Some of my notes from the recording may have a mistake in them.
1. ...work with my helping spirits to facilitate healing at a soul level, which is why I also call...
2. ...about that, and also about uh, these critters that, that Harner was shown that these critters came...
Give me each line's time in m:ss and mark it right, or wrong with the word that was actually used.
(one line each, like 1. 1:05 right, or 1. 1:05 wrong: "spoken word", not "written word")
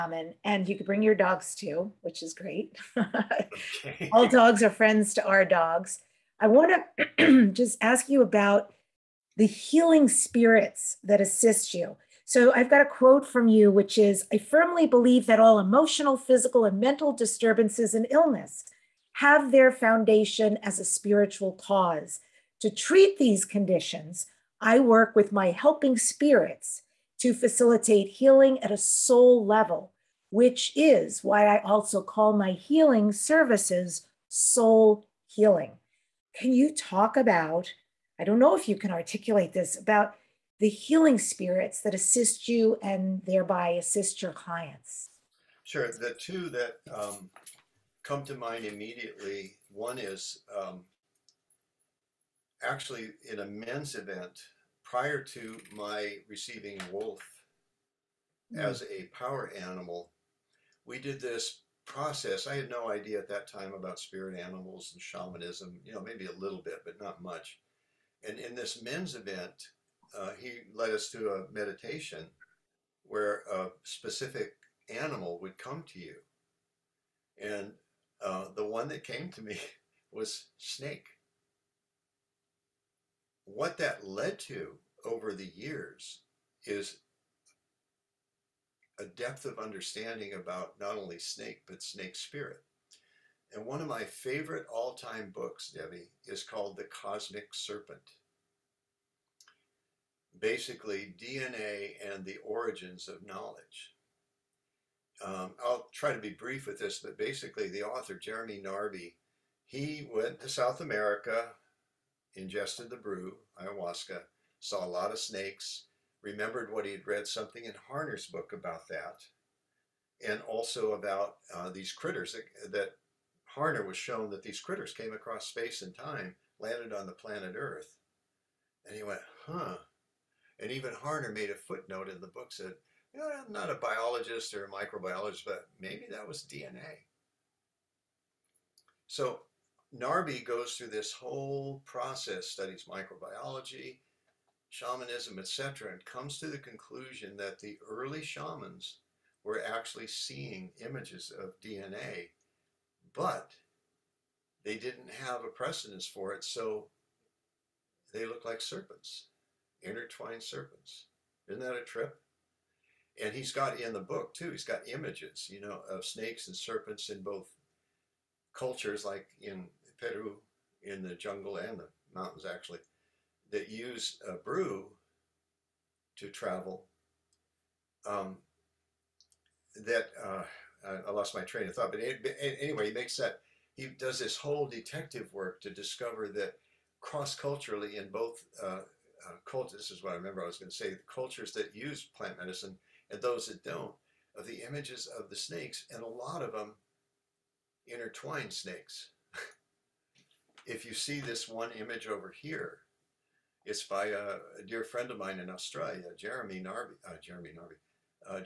1. 0:24 right
2. 1:58 right.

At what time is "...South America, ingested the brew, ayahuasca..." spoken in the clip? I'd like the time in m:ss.
1:50.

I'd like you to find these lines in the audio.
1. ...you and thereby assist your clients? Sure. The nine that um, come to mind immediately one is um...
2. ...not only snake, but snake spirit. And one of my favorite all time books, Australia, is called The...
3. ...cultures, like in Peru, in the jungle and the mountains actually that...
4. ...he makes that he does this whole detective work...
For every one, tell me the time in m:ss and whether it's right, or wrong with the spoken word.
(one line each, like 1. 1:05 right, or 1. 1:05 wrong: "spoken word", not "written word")
1. 0:42 wrong: "two", not "nine"
2. 1:30 wrong: "Debbi", not "Australia"
3. 2:48 right
4. 3:02 right.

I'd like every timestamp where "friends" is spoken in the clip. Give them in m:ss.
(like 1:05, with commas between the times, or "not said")
0:04, 3:24.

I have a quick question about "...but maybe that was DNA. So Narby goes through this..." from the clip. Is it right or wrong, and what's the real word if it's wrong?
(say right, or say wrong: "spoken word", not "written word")
right.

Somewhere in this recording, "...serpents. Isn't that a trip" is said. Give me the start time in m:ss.
2:40.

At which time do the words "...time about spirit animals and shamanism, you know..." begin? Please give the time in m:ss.
1:03.